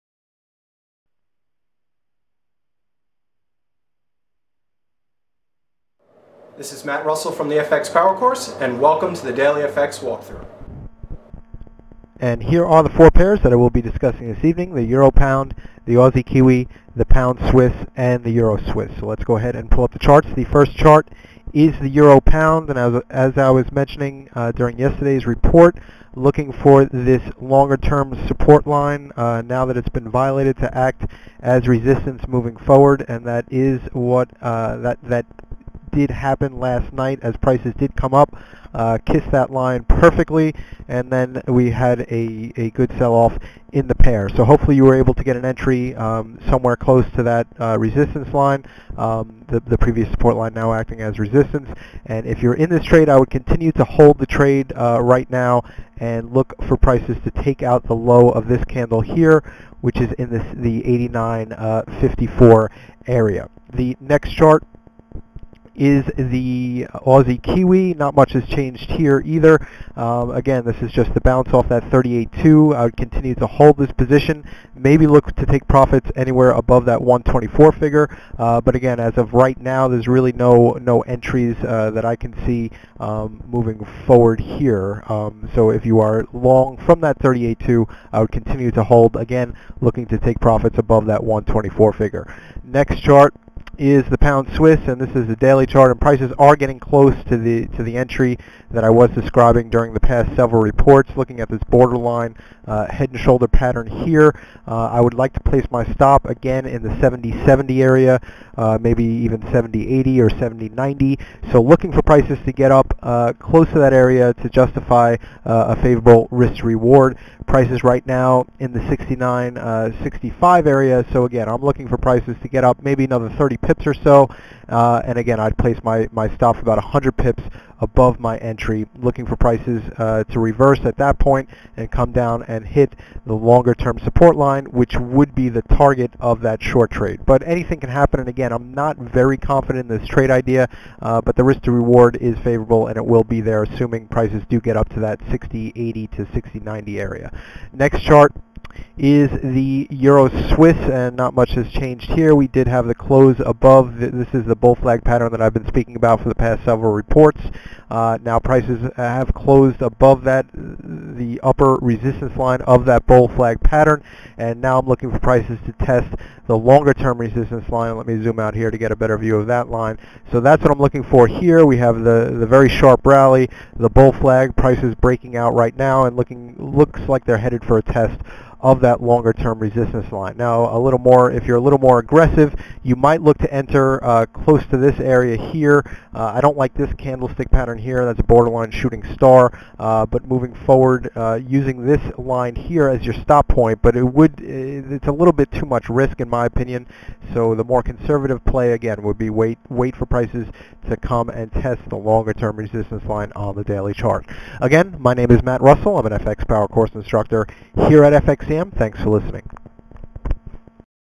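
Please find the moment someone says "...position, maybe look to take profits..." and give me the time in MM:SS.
01:13.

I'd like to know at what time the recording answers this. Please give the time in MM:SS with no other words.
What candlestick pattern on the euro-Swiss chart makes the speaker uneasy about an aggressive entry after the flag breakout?
03:08.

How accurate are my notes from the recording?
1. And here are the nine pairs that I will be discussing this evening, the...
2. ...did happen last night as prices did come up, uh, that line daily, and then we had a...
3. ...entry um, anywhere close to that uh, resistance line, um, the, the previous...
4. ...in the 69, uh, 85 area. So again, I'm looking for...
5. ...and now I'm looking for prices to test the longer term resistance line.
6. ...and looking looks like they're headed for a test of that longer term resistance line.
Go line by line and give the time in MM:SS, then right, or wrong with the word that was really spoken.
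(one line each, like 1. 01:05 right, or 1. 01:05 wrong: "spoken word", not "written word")
1. 00:12 wrong: "four", not "nine"
2. 00:35 wrong: "perfectly", not "daily"
3. 00:45 wrong: "somewhere", not "anywhere"
4. 01:58 wrong: "65", not "85"
5. 02:44 right
6. 02:56 right.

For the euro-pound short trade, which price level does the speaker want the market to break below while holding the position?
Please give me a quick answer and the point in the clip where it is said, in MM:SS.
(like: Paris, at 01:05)
89.54, at 01:00.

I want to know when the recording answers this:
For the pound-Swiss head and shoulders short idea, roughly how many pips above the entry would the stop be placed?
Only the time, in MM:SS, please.
02:06.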